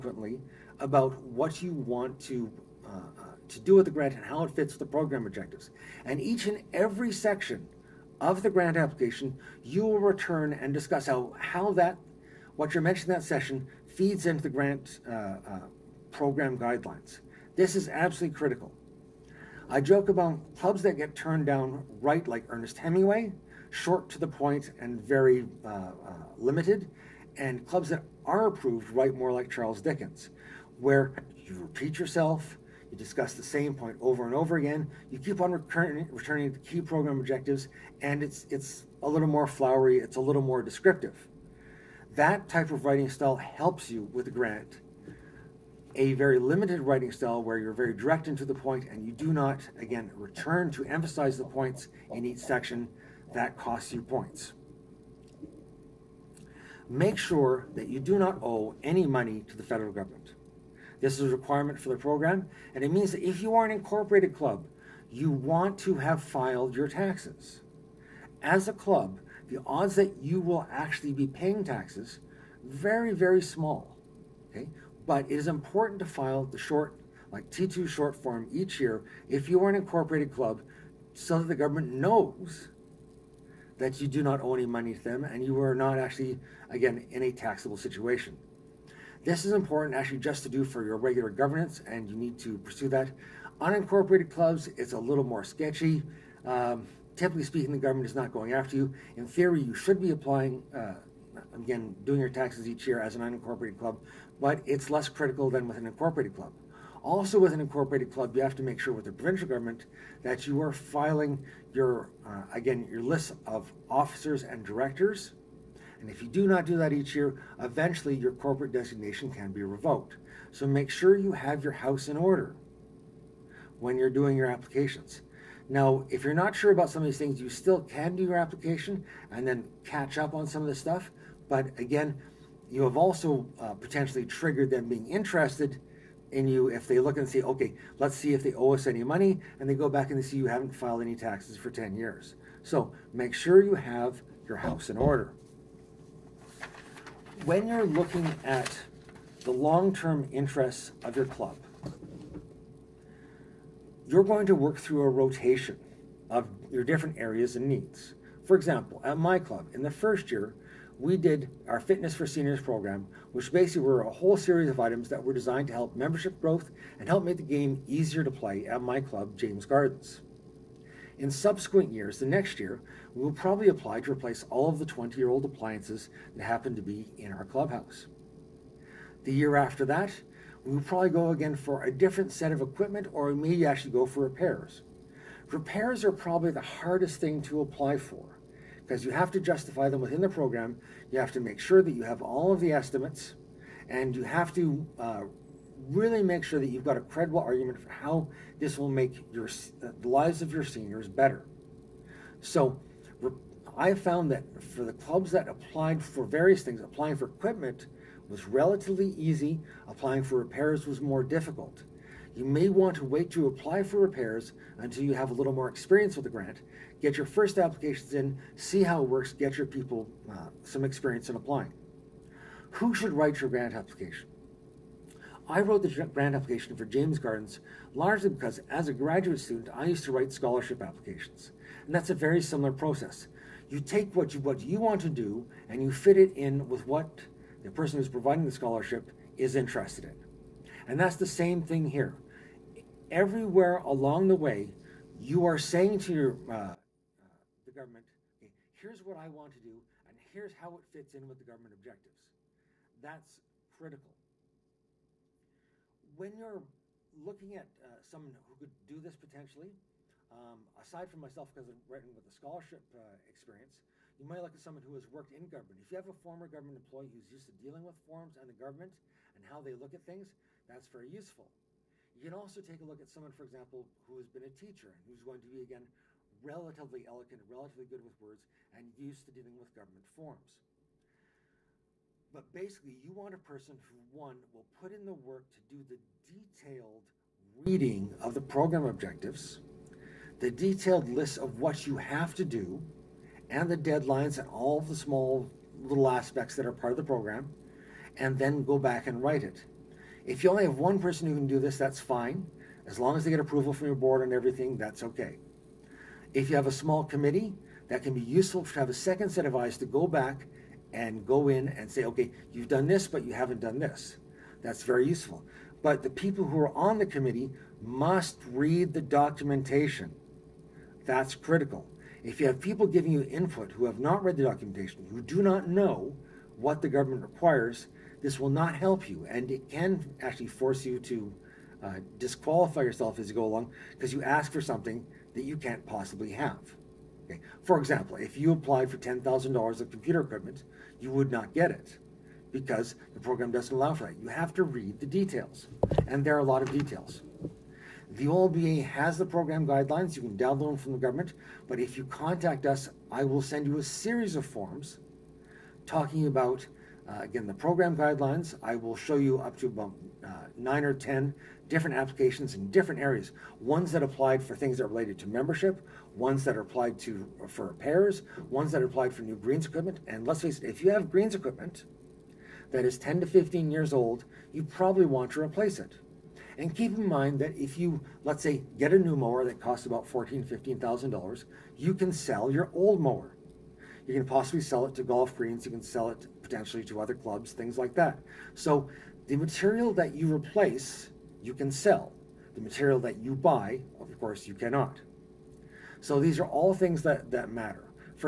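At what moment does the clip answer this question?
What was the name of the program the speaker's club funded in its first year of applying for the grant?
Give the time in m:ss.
2:41.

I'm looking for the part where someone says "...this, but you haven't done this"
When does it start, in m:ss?
5:12.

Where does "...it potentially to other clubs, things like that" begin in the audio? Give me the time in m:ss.
6:26.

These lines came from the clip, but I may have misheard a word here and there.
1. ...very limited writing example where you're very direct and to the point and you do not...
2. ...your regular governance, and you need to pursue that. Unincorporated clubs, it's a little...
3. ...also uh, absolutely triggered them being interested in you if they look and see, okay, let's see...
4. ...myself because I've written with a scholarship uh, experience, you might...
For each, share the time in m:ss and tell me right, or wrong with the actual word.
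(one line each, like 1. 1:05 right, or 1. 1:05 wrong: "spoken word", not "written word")
1. 0:46 wrong: "style", not "example"
2. 1:30 right
3. 2:12 wrong: "potentially", not "absolutely"
4. 4:21 right.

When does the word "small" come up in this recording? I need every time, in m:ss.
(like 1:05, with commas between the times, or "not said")
1:13, 4:54, 5:06.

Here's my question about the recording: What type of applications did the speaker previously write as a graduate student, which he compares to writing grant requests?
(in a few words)
scholarship applications.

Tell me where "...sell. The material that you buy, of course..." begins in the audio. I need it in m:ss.
6:31.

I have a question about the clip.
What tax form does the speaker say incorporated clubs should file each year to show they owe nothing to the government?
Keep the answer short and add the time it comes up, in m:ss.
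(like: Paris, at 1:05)
T2 short form, at 1:17.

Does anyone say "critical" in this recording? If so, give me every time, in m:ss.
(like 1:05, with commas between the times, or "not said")
0:18, 1:45, 4:13, 5:21.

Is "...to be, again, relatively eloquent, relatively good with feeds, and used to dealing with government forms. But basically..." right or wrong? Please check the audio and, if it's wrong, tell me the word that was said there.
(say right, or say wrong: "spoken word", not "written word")
wrong: "words", not "feeds".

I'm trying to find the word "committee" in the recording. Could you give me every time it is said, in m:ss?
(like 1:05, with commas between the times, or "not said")
5:07, 5:17.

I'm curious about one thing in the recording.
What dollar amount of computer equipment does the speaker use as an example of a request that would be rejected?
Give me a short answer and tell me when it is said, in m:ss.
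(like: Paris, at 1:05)
$10,000, at 5:38.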